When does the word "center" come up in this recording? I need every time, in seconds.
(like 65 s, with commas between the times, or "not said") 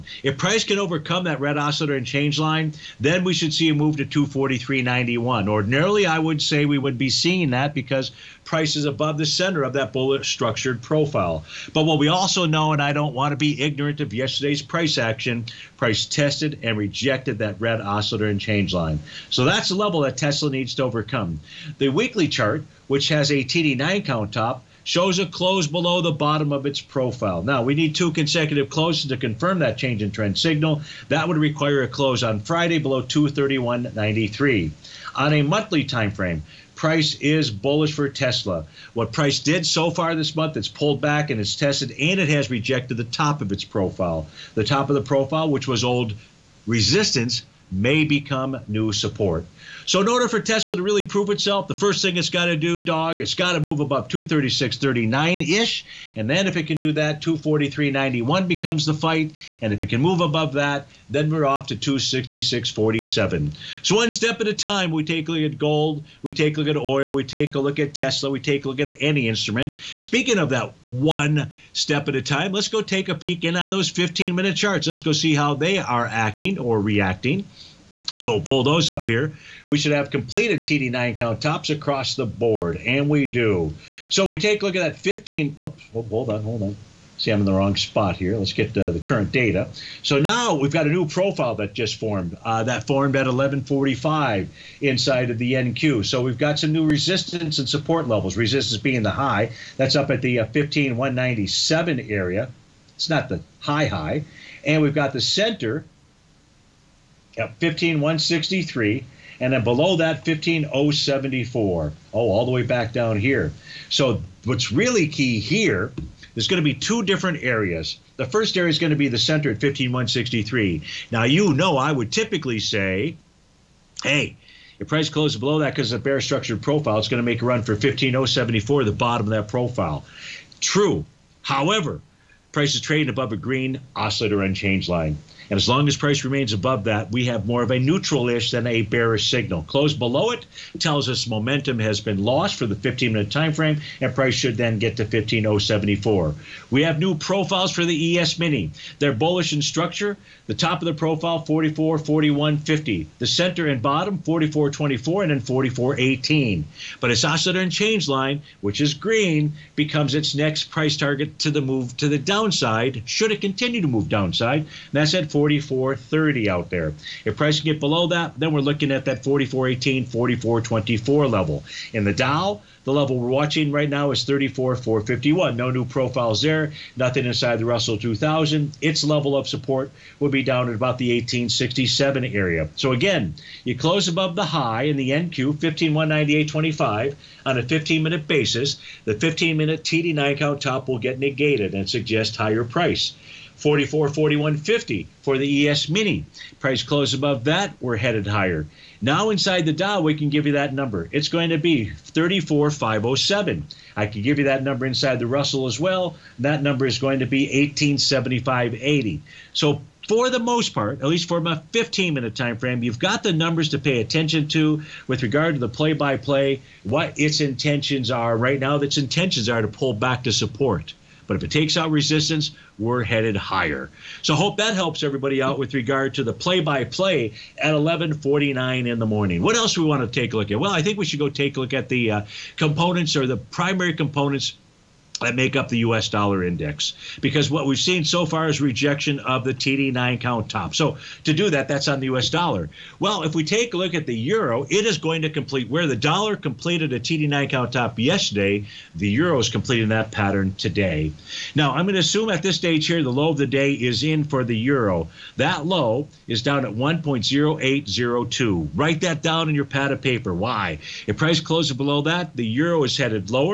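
9 s, 105 s, 119 s, 153 s.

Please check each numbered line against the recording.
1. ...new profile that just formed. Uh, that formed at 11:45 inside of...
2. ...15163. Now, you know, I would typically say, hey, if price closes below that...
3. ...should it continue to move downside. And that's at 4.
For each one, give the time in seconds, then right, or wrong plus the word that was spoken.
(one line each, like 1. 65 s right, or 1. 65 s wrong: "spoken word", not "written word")
1. 90 s right
2. 119 s right
3. 163 s right.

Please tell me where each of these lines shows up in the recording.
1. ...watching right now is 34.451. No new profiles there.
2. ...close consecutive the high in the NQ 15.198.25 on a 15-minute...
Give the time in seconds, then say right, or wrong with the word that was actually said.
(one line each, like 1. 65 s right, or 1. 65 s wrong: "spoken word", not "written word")
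1. 173 s right
2. 183 s wrong: "above", not "consecutive".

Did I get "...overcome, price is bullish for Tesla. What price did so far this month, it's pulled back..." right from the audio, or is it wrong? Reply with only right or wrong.
wrong.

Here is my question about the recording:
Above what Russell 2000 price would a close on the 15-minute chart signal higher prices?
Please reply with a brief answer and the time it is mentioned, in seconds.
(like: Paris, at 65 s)
1875.80, at 207 s.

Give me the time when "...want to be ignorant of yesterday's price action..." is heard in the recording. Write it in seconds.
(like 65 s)
13 s.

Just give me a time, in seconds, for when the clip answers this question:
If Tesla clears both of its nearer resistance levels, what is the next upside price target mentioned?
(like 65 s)
61 s.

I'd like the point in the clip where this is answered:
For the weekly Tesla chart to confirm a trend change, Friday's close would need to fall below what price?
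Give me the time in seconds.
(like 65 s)
33 s.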